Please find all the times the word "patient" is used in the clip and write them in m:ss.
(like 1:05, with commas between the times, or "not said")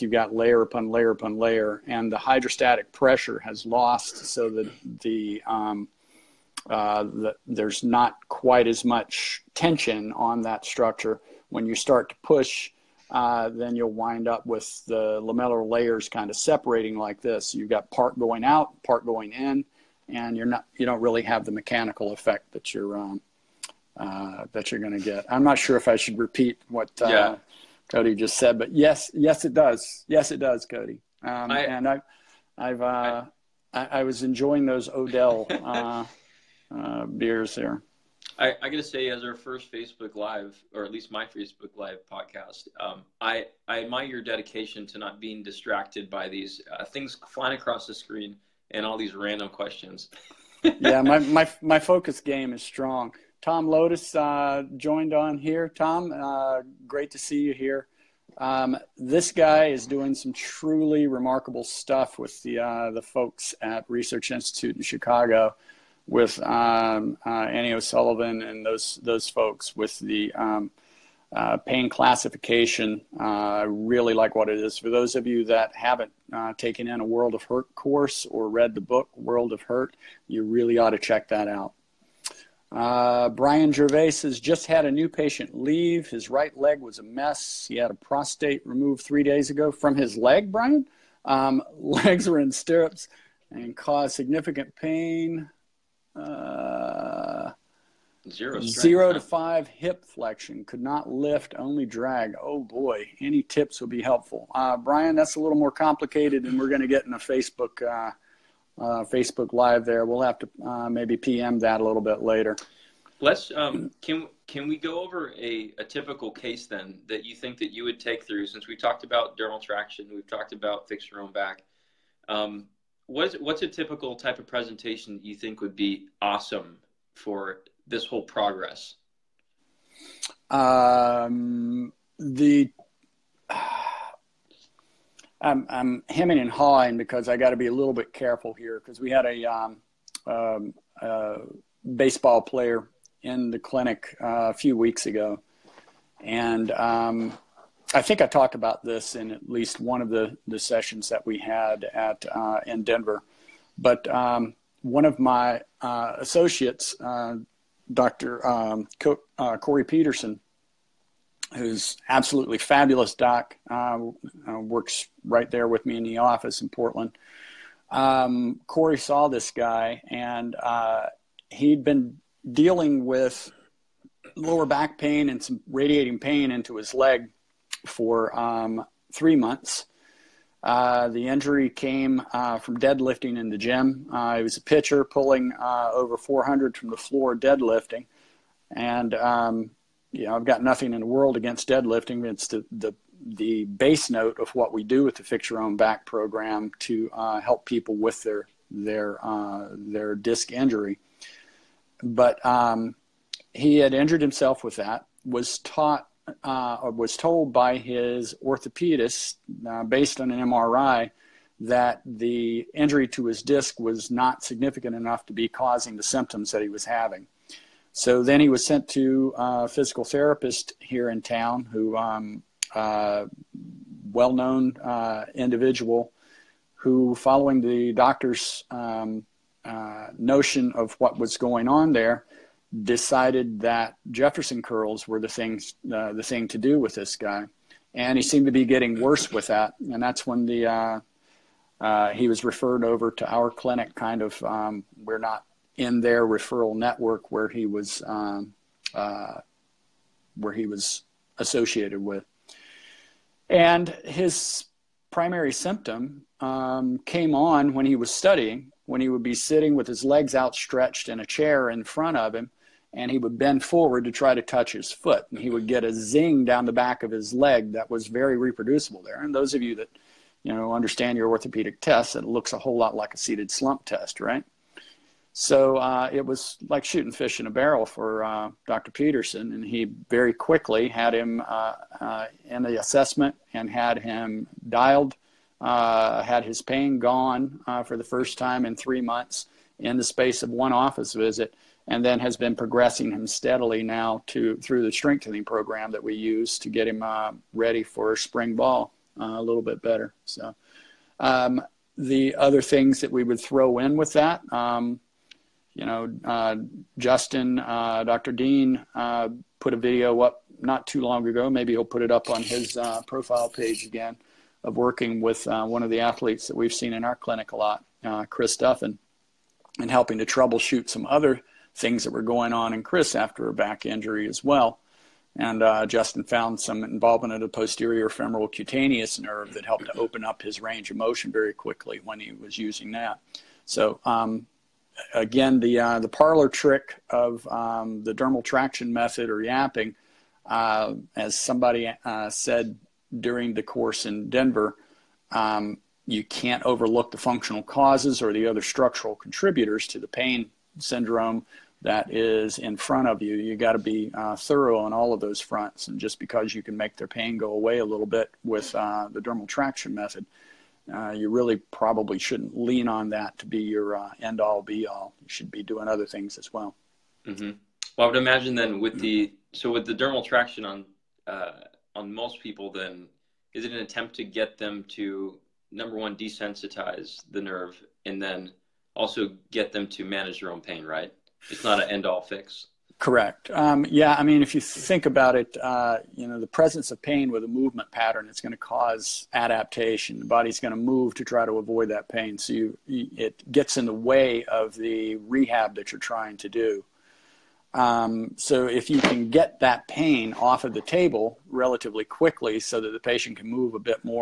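1:25, 6:42.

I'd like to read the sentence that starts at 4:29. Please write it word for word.
And those of you that, you know, understand your orthopedic tests, it looks a whole lot like a seated slump test, right?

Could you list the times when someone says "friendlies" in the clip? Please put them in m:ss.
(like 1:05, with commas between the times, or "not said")
not said.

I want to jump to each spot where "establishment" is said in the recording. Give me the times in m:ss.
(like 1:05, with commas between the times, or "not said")
not said.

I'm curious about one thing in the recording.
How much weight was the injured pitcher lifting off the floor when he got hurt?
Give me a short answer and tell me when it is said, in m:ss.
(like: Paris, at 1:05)
over 400, at 3:05.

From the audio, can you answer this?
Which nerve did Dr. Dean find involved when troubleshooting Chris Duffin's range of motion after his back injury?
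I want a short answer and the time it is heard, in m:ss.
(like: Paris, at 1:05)
posterior femoral cutaneous nerve, at 5:27.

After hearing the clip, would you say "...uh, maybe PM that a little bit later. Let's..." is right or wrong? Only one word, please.
right.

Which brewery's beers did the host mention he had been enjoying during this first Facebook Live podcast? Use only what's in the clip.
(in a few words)
Odell.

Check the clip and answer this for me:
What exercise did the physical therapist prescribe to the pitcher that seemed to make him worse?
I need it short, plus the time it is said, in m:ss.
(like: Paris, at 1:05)
Jefferson curls, at 3:54.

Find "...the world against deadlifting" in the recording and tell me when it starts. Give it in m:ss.
3:10.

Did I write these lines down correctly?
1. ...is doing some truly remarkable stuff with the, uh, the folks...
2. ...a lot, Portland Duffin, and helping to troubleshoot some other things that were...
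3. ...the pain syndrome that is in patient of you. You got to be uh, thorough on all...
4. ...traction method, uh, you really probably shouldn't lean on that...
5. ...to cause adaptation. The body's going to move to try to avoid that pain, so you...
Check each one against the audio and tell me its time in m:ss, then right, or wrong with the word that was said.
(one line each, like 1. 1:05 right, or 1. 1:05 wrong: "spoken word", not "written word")
1. 0:59 right
2. 5:17 wrong: "Chris", not "Portland"
3. 5:49 wrong: "front", not "patient"
4. 5:59 right
5. 6:28 right.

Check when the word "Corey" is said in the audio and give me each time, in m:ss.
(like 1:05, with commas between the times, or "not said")
2:39, 2:48.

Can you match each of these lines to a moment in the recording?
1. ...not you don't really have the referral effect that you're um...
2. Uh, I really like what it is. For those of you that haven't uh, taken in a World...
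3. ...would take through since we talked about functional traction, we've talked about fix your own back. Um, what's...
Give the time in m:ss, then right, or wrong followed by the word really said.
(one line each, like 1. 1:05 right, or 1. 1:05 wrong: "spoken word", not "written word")
1. 0:20 wrong: "mechanical", not "referral"
2. 1:13 right
3. 1:57 wrong: "dermal", not "functional".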